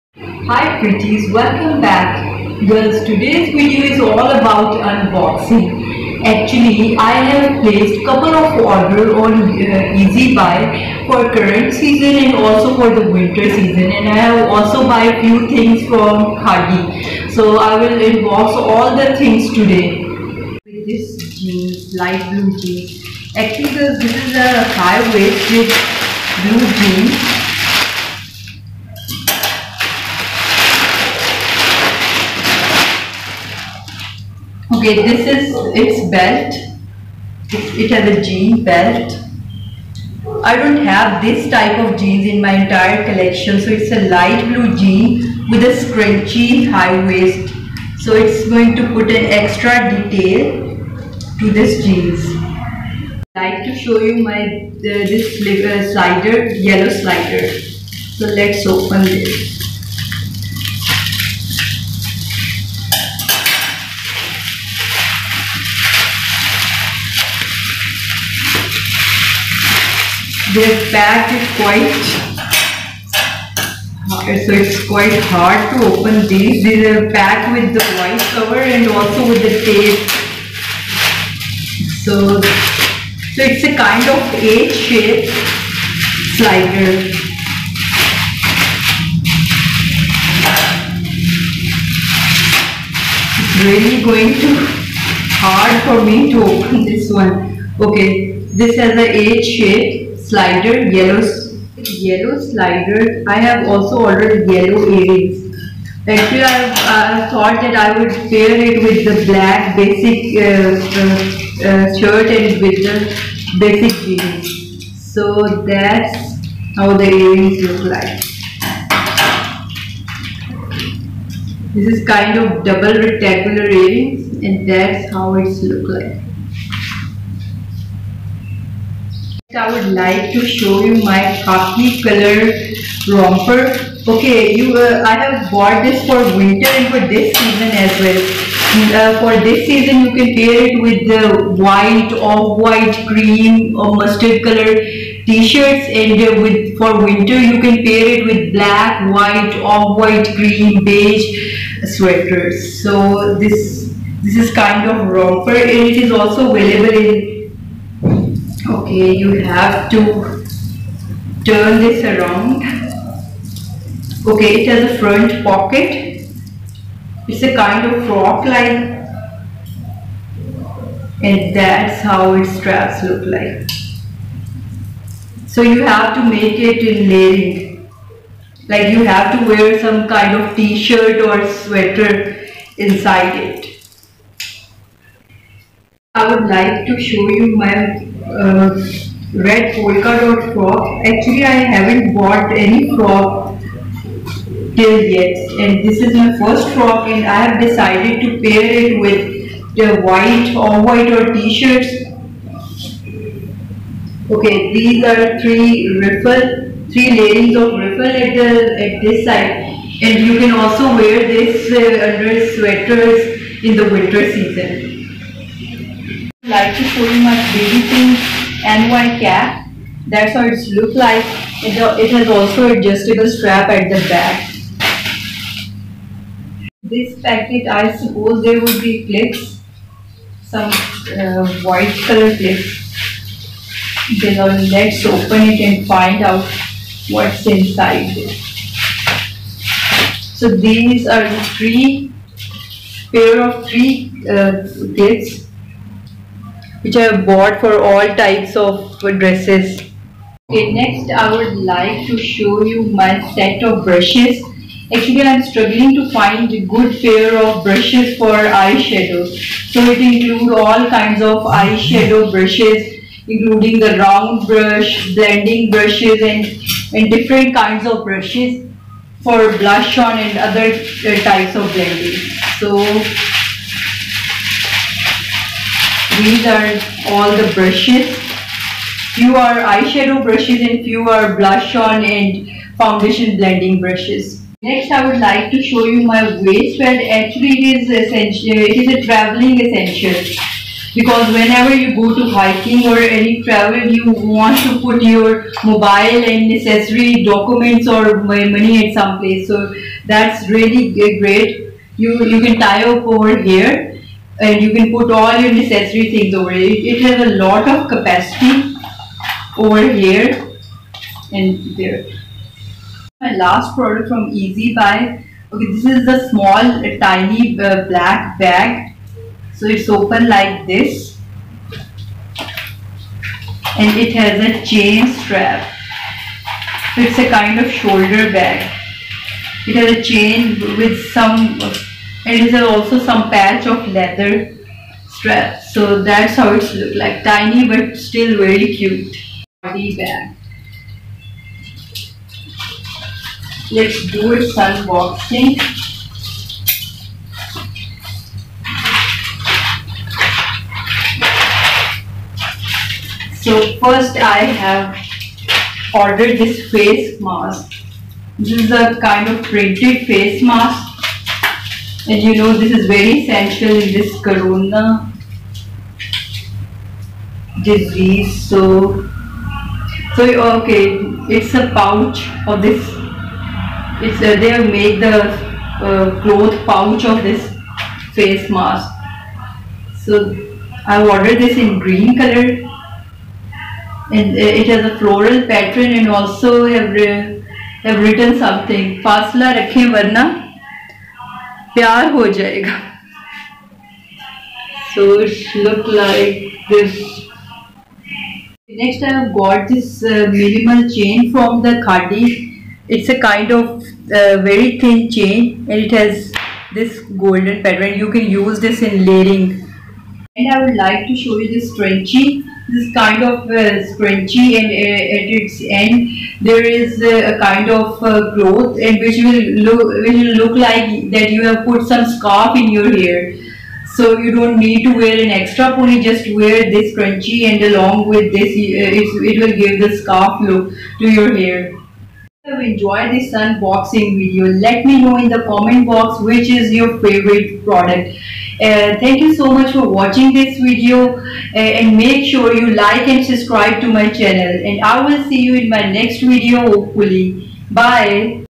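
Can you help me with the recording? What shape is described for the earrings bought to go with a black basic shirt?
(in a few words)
Double rectangular.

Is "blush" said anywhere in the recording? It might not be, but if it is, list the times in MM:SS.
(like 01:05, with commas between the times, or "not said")
04:29, 04:41.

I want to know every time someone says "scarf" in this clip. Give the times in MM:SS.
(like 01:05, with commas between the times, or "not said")
07:02, 07:09.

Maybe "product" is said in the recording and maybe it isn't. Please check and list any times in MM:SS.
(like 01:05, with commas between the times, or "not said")
05:13, 07:17.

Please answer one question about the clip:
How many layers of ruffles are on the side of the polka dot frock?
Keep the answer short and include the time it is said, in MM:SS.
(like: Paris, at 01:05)
3, at 03:26.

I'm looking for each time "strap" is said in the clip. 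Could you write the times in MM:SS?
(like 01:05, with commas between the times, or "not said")
02:52, 03:43, 05:25, 05:35.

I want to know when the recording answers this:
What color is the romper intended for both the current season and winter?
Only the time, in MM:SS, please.
02:11.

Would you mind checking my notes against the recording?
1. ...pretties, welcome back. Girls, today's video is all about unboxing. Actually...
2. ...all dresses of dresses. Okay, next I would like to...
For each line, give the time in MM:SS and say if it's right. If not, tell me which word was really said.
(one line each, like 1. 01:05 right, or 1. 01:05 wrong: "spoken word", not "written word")
1. 00:00 right
2. 04:07 wrong: "types", not "dresses".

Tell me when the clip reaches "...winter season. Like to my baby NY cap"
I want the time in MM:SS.
03:33.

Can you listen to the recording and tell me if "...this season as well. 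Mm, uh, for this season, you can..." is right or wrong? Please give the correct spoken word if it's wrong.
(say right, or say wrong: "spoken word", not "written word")
right.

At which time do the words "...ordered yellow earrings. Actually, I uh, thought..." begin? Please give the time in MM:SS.
01:44.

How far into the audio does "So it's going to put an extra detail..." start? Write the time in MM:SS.
00:47.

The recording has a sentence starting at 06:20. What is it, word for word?
So, I ordered this in green color, and it has a floral pattern, and also have have written something.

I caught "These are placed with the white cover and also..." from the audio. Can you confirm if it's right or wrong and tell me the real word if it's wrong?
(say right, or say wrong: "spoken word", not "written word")
wrong: "packed", not "placed".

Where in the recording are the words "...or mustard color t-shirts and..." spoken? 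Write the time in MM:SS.
02:23.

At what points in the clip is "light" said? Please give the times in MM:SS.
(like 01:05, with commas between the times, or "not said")
00:21, 00:44.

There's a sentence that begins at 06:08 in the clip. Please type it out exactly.
So, so okay, it's a pouch of this.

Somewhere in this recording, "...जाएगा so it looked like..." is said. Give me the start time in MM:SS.
06:32.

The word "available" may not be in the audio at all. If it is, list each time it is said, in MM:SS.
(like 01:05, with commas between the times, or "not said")
02:36.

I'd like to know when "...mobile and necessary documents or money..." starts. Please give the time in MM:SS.
04:55.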